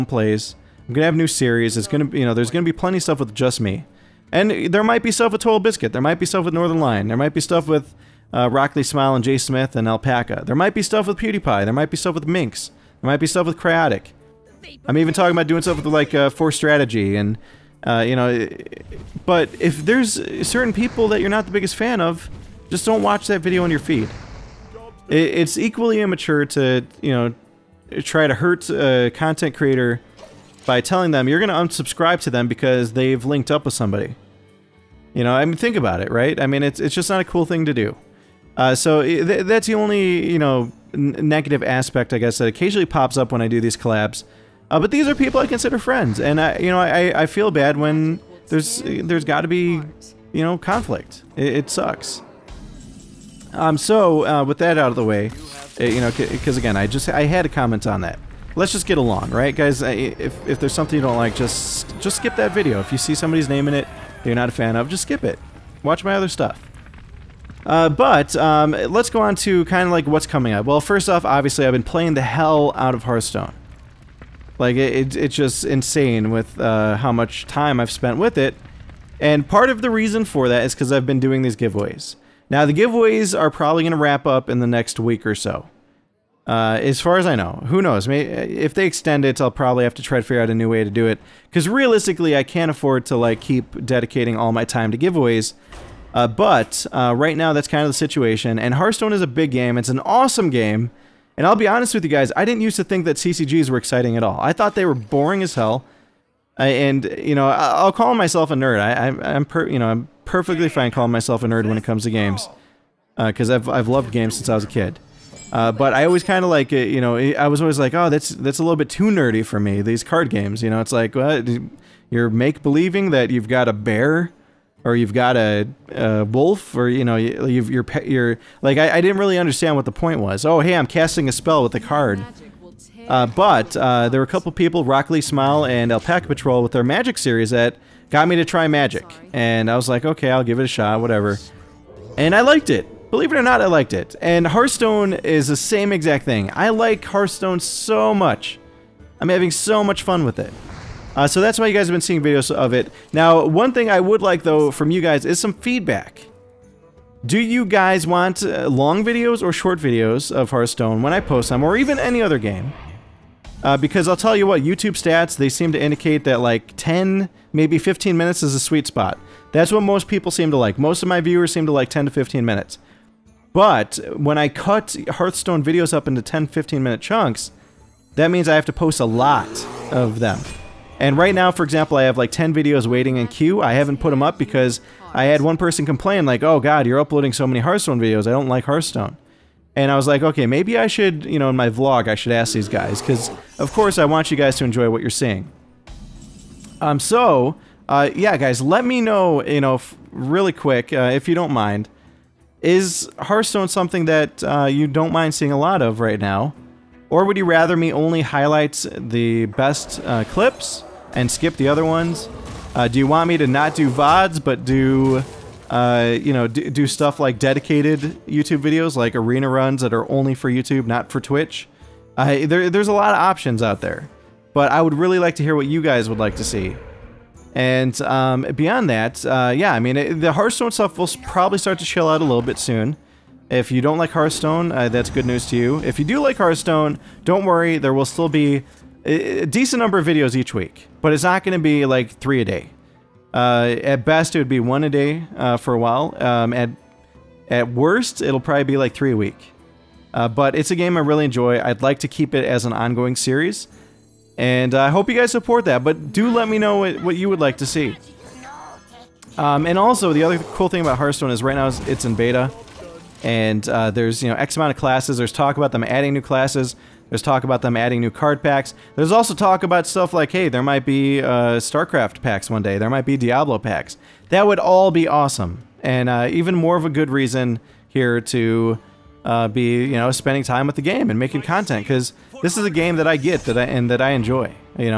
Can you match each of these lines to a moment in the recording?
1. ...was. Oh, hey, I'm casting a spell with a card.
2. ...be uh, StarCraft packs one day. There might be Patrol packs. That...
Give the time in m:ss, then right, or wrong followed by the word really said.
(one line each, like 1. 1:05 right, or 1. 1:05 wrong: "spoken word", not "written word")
1. 2:10 right
2. 4:30 wrong: "Diablo", not "Patrol".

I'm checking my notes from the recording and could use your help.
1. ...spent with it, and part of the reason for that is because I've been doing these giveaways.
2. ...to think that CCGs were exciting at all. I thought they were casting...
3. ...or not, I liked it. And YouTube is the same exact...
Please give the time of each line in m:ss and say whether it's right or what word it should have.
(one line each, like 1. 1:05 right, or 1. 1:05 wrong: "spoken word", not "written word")
1. 1:17 right
2. 1:42 wrong: "boring", not "casting"
3. 2:23 wrong: "Hearthstone", not "YouTube".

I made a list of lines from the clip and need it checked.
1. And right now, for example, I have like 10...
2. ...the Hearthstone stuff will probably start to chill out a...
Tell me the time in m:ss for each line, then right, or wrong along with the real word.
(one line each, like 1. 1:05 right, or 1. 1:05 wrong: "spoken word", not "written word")
1. 3:00 right
2. 3:50 right.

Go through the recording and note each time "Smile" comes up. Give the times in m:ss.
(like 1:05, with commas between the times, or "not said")
0:08, 2:15.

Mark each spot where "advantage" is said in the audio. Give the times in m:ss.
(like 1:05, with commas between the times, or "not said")
not said.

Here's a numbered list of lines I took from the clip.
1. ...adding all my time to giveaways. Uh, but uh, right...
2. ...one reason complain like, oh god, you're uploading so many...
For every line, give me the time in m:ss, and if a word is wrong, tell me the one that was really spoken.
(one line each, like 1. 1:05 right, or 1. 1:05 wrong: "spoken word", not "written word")
1. 1:33 wrong: "dedicating", not "adding"
2. 3:05 wrong: "person", not "reason".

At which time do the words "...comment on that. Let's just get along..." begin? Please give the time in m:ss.
0:57.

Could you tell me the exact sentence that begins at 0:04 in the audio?
And there might be stuff with Total Biscuit.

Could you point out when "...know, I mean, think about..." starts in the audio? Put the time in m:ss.
0:35.